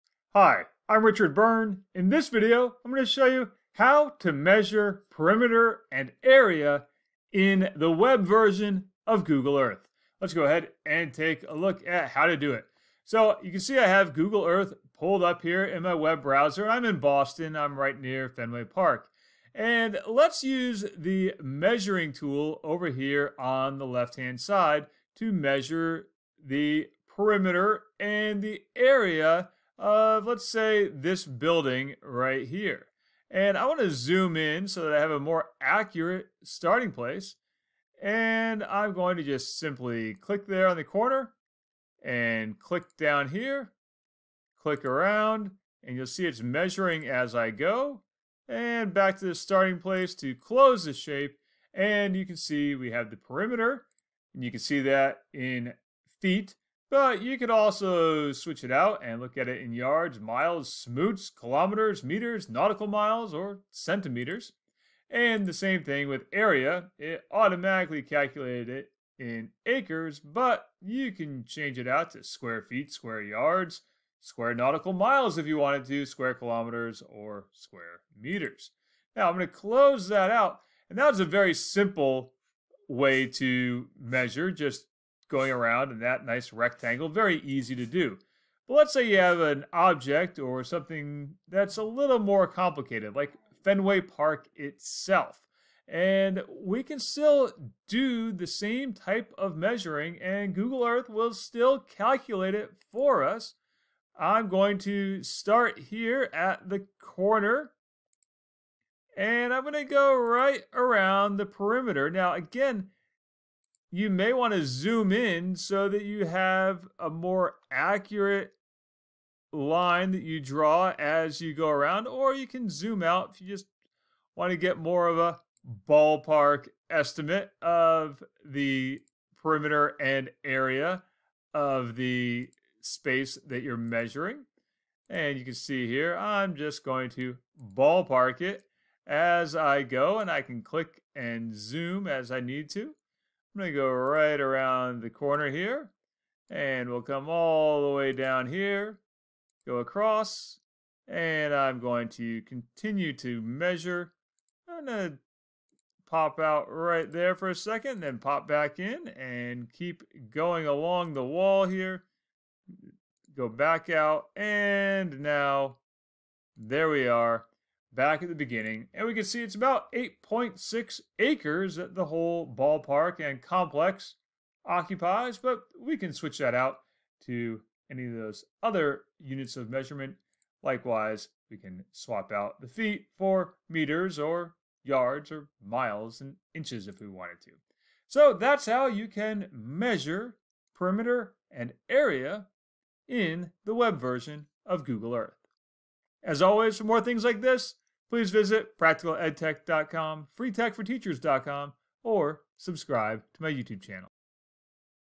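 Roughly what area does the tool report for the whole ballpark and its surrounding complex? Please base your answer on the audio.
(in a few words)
8.6 acres.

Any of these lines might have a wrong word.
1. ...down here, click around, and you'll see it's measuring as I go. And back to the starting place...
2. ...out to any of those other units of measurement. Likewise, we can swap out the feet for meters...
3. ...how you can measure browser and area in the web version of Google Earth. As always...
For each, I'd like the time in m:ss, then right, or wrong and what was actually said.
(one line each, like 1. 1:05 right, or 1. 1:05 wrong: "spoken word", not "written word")
1. 0:42 right
2. 2:56 right
3. 3:08 wrong: "perimeter", not "browser".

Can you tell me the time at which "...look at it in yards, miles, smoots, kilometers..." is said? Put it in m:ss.
0:59.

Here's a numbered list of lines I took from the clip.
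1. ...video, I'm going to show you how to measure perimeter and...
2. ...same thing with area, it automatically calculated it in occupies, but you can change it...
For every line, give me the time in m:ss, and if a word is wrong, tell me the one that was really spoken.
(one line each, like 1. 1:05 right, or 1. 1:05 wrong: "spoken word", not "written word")
1. 0:02 right
2. 1:05 wrong: "acres", not "occupies".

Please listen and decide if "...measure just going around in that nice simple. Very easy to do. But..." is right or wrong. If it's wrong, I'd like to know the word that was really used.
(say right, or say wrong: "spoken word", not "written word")
wrong: "rectangle", not "simple".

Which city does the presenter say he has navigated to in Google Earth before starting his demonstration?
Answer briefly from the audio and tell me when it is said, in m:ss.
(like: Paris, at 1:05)
Boston, at 0:17.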